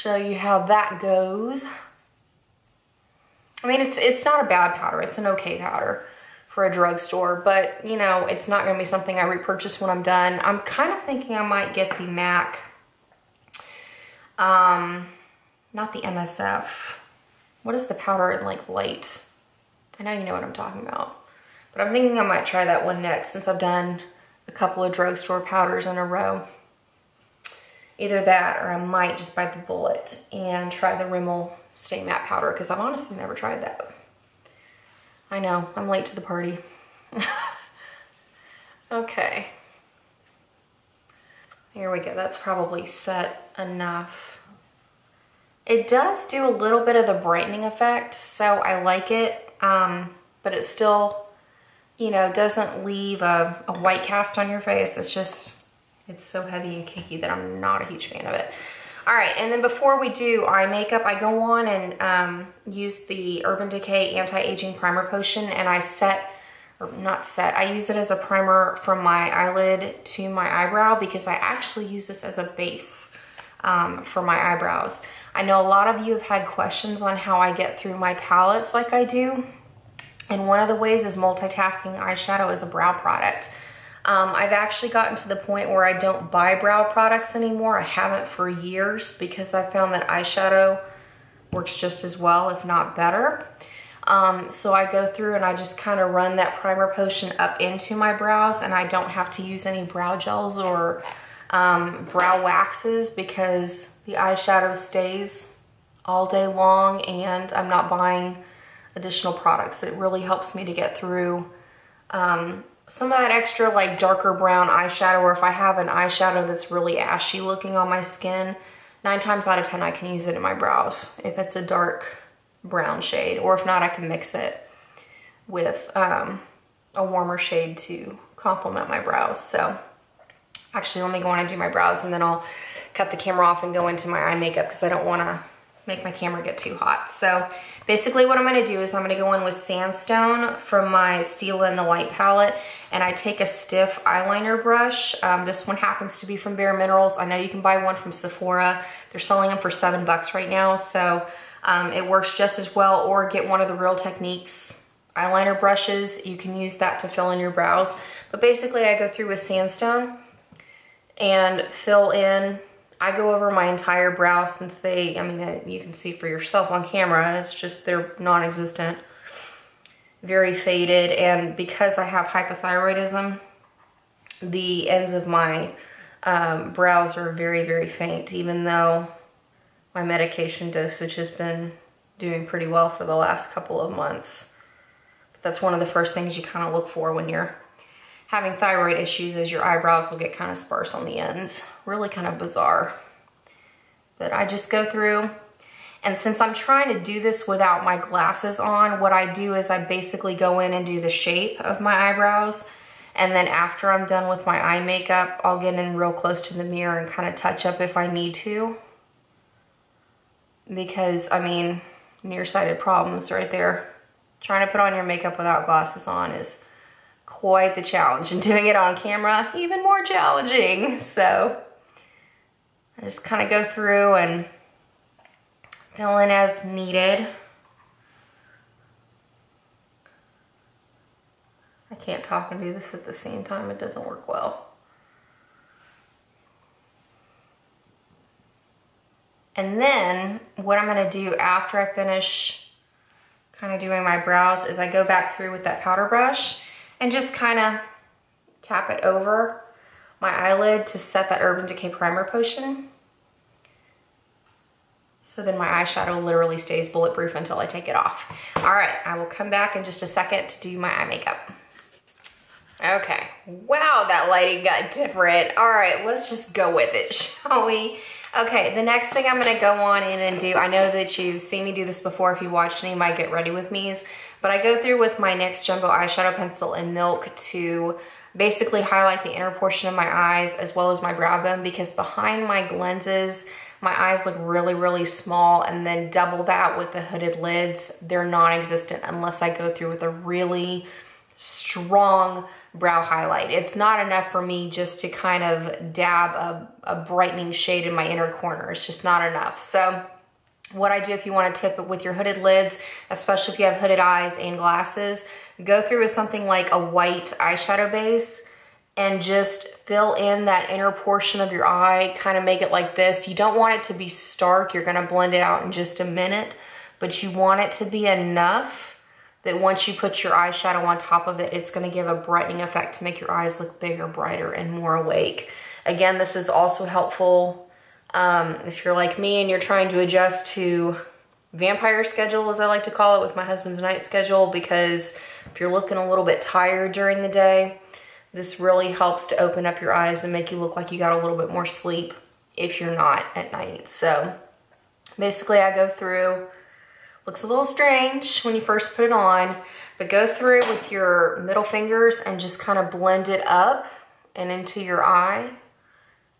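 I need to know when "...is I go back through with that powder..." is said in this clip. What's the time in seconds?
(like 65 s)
244 s.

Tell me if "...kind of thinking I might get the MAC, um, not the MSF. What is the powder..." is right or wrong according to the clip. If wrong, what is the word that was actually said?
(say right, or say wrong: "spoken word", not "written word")
right.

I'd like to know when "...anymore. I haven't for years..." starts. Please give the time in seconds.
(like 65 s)
87 s.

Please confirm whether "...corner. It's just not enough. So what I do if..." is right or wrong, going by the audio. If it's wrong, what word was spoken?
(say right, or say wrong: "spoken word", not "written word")
right.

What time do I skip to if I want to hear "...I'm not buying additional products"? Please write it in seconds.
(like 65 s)
107 s.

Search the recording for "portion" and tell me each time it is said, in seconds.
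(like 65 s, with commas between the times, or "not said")
279 s, 310 s.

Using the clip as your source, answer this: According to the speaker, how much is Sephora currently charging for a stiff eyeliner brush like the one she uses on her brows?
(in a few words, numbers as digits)
$7.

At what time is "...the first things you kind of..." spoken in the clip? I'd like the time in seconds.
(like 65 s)
185 s.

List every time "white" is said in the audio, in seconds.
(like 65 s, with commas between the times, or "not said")
53 s, 306 s.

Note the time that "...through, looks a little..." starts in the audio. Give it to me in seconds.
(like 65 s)
345 s.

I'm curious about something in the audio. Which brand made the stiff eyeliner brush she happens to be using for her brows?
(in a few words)
Bare Minerals.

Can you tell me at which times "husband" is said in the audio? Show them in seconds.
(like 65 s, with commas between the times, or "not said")
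333 s.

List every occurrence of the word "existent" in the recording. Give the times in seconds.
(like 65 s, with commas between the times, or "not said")
168 s, 288 s.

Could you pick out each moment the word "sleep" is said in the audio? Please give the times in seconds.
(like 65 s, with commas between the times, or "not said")
341 s.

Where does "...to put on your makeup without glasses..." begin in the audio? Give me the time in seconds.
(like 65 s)
214 s.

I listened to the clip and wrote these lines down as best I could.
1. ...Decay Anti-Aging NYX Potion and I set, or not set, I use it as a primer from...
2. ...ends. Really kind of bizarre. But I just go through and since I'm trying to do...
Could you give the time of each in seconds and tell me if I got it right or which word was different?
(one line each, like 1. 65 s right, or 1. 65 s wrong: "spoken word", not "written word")
1. 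63 s wrong: "Primer", not "NYX"
2. 191 s right.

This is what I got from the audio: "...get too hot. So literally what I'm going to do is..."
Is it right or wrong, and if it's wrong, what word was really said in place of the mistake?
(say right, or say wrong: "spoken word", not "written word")
wrong: "basically", not "literally".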